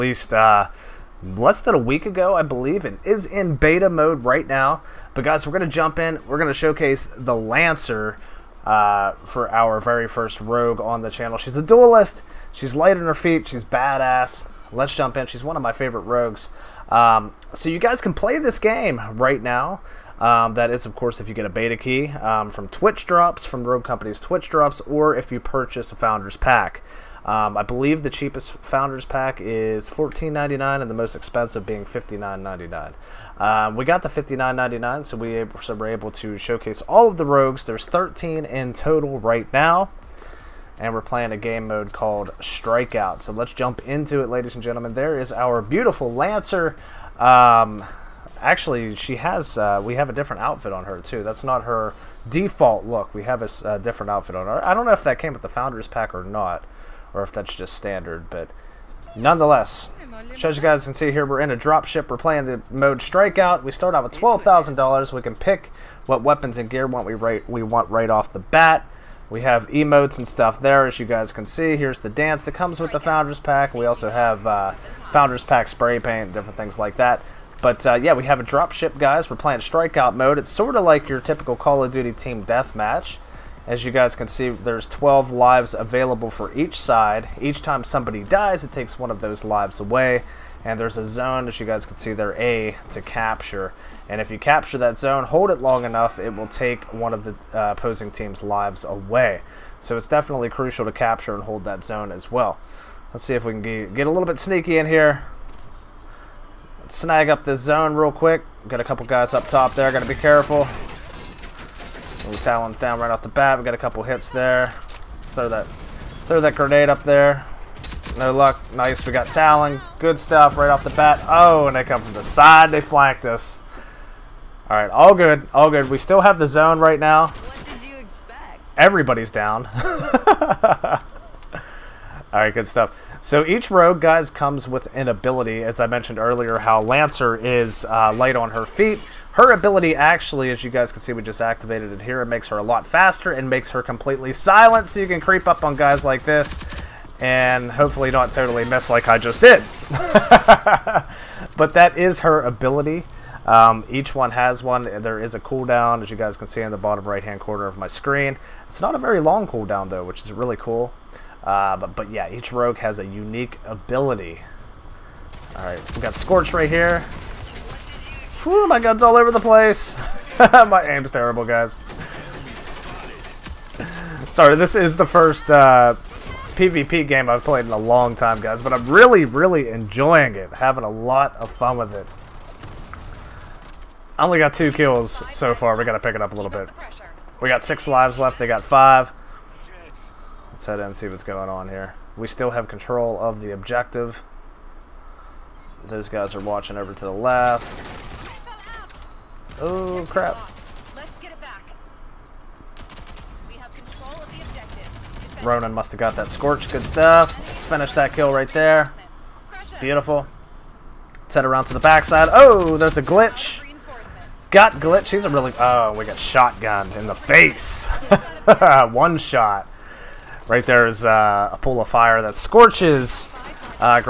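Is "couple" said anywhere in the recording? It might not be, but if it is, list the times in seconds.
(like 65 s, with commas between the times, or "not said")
108 s, 113 s.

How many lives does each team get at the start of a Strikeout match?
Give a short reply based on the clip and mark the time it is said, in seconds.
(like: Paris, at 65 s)
12, at 84 s.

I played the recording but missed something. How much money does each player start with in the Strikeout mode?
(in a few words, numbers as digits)
$12,000.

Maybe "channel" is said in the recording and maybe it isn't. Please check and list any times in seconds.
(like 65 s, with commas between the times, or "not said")
11 s.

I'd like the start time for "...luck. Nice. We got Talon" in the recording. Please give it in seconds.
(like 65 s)
118 s.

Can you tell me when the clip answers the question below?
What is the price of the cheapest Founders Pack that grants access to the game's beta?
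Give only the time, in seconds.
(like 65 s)
29 s.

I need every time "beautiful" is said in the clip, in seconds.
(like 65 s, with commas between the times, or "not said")
45 s, 209 s.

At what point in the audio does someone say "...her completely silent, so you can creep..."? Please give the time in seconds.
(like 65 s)
143 s.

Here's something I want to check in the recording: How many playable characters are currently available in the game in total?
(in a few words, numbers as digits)
13.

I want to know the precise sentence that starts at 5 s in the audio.
But guys, we're going to jump in.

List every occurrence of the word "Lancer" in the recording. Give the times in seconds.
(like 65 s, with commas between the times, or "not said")
7 s, 46 s, 136 s.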